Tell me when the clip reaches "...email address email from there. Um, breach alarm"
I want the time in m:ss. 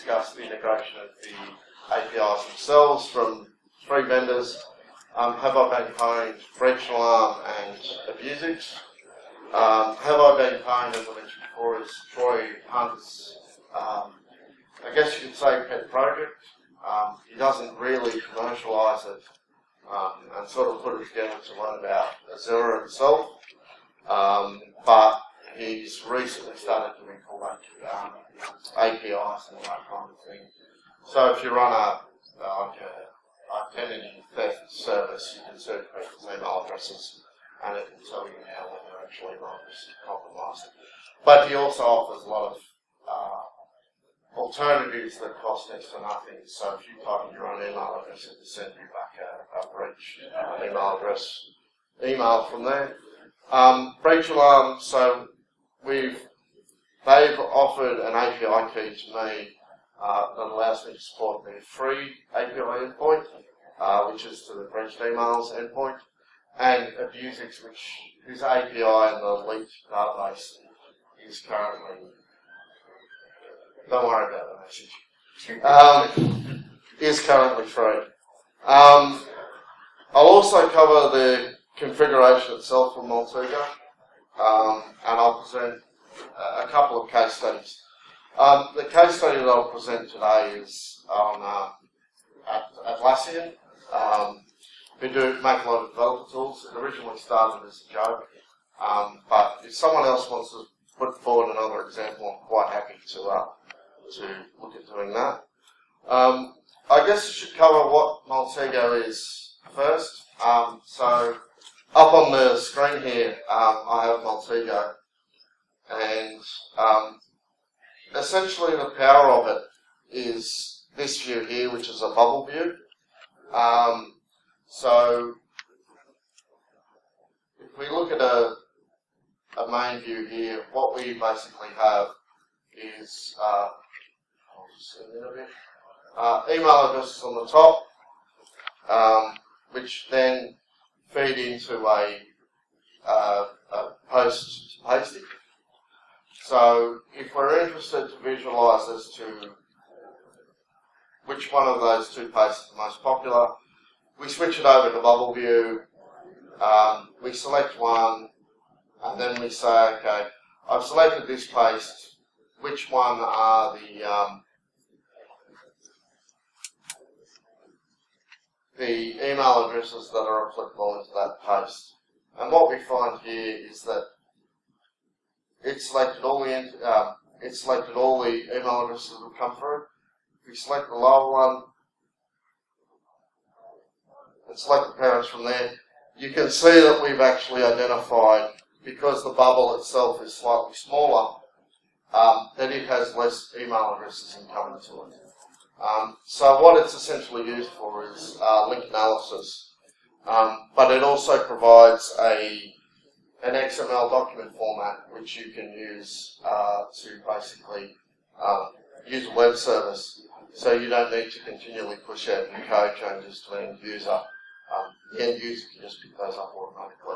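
0:50.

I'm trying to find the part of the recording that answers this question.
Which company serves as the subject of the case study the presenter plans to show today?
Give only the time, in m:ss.
1:32.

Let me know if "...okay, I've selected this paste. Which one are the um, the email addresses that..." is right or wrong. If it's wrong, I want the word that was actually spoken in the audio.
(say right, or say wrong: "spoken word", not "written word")
right.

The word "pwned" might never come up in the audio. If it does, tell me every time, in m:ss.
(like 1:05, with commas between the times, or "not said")
0:05, 0:10.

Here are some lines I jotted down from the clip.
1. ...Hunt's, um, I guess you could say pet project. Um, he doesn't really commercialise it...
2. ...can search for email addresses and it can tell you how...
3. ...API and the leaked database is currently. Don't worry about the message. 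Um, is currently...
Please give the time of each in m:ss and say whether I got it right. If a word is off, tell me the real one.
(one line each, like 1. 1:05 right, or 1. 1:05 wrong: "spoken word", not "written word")
1. 0:12 right
2. 0:35 right
3. 1:08 right.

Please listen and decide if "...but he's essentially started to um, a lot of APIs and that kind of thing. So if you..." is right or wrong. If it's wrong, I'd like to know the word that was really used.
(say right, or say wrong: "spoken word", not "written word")
wrong: "recently", not "essentially".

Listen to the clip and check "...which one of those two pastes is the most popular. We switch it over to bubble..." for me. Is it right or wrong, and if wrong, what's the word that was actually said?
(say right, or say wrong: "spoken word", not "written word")
right.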